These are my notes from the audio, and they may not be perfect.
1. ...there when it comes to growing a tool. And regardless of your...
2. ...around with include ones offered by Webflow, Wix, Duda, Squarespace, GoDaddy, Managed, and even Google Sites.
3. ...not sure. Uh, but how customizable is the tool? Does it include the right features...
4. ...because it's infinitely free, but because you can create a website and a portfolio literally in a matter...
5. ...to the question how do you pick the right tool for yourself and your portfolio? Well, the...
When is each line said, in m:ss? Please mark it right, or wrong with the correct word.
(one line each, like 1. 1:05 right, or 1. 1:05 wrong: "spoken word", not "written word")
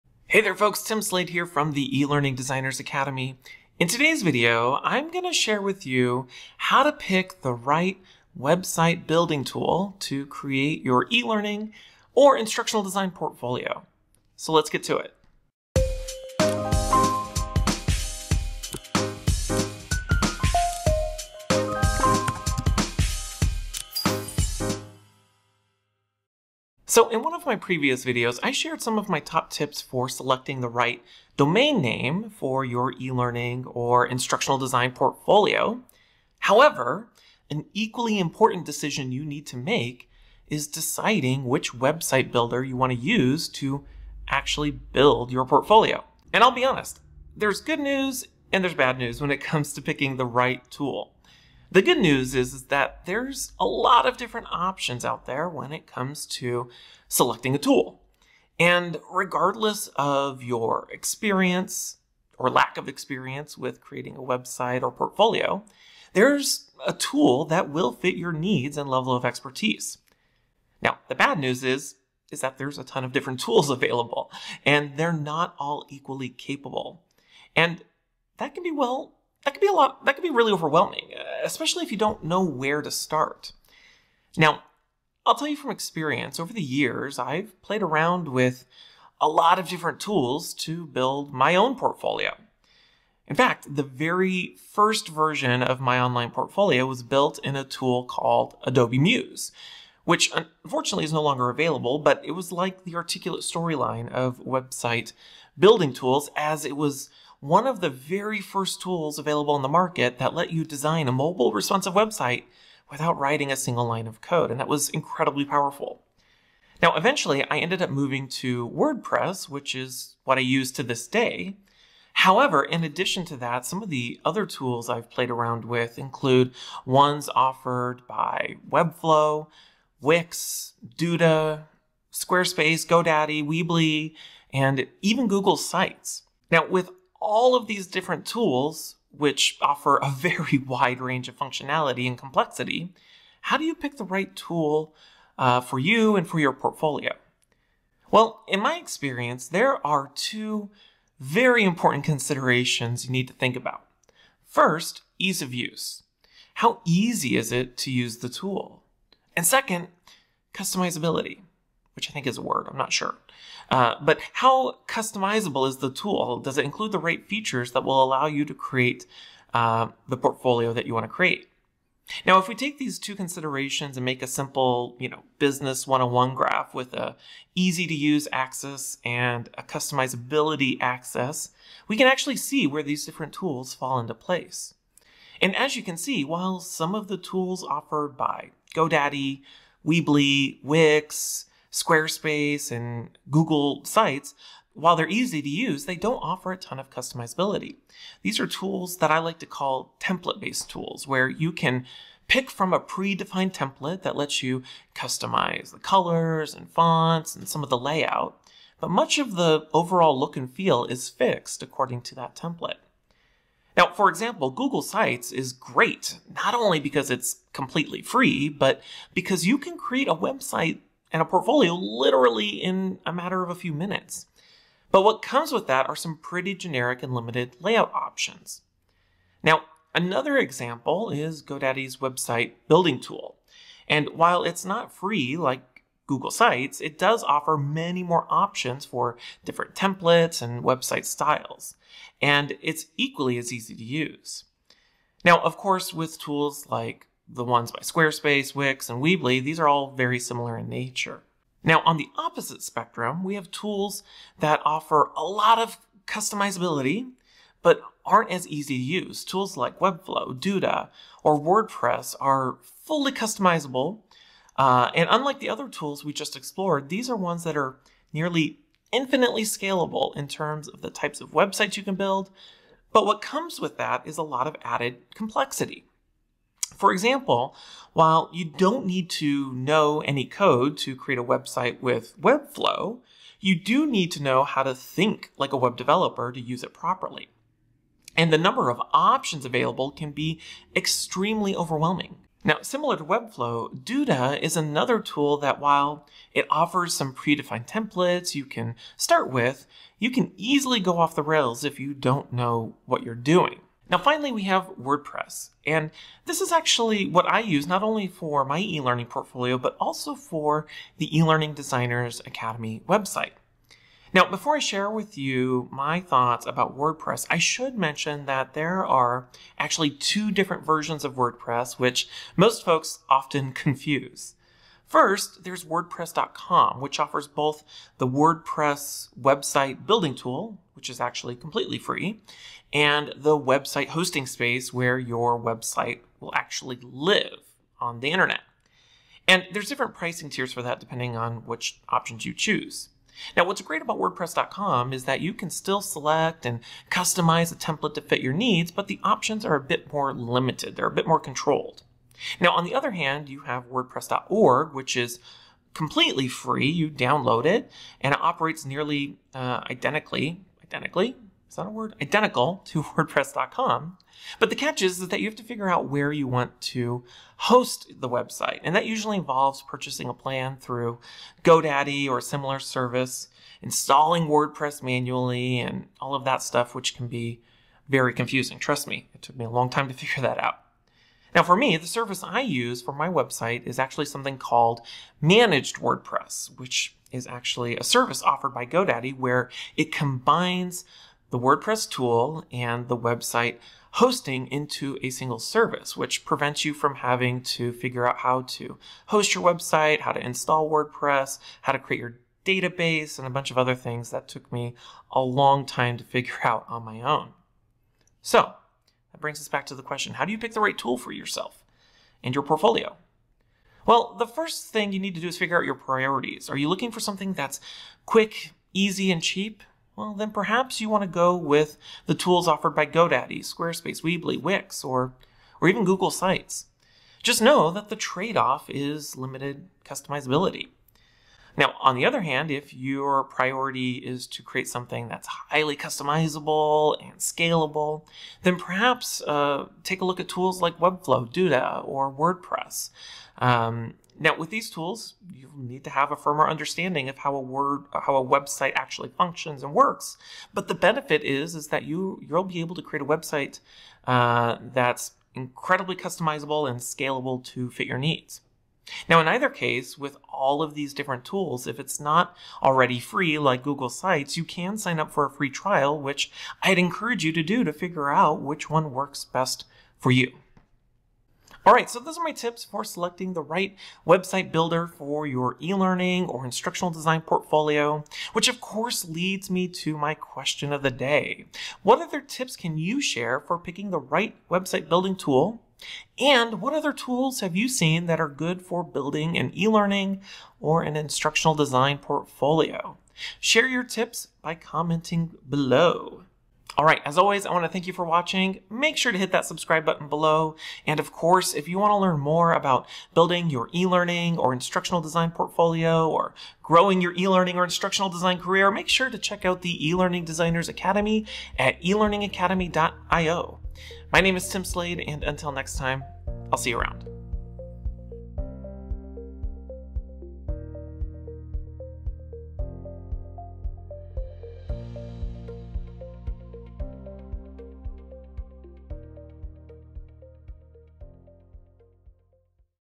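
1. 0:55 wrong: "selecting", not "growing"
2. 2:05 wrong: "Weebly", not "Managed"
3. 2:42 right
4. 3:36 wrong: "completely", not "infinitely"
5. 6:49 right.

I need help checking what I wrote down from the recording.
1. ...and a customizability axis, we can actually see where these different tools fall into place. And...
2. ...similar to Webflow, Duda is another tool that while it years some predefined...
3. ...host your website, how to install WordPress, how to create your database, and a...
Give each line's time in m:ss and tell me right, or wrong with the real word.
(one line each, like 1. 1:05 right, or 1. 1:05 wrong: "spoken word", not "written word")
1. 2:59 right
2. 4:52 wrong: "offers", not "years"
3. 6:39 right.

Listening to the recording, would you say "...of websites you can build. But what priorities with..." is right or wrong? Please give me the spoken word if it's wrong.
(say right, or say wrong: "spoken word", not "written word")
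wrong: "comes", not "priorities".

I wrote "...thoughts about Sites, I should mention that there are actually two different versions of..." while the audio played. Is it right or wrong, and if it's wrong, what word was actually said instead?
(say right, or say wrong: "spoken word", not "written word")
wrong: "WordPress", not "Sites".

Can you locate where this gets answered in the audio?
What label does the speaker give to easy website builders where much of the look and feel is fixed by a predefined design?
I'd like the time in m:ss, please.
3:19.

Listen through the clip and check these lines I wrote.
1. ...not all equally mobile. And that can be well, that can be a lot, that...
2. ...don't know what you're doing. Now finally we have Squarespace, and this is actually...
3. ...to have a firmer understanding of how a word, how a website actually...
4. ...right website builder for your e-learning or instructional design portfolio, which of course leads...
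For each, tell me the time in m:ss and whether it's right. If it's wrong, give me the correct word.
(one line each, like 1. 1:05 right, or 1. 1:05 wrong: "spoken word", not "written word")
1. 1:15 wrong: "capable", not "mobile"
2. 5:01 wrong: "WordPress", not "Squarespace"
3. 7:25 right
4. 7:53 right.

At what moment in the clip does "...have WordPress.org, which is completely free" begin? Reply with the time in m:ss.
5:53.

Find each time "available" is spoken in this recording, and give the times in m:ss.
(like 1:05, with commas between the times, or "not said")
1:13, 1:41, 1:49, 4:49.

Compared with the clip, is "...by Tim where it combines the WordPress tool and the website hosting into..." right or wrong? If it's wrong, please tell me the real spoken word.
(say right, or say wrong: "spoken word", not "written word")
wrong: "GoDaddy", not "Tim".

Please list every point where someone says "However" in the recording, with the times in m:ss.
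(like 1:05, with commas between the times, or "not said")
0:36, 2:02.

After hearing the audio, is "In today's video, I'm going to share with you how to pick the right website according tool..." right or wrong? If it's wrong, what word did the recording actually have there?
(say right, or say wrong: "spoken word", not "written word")
wrong: "building", not "according".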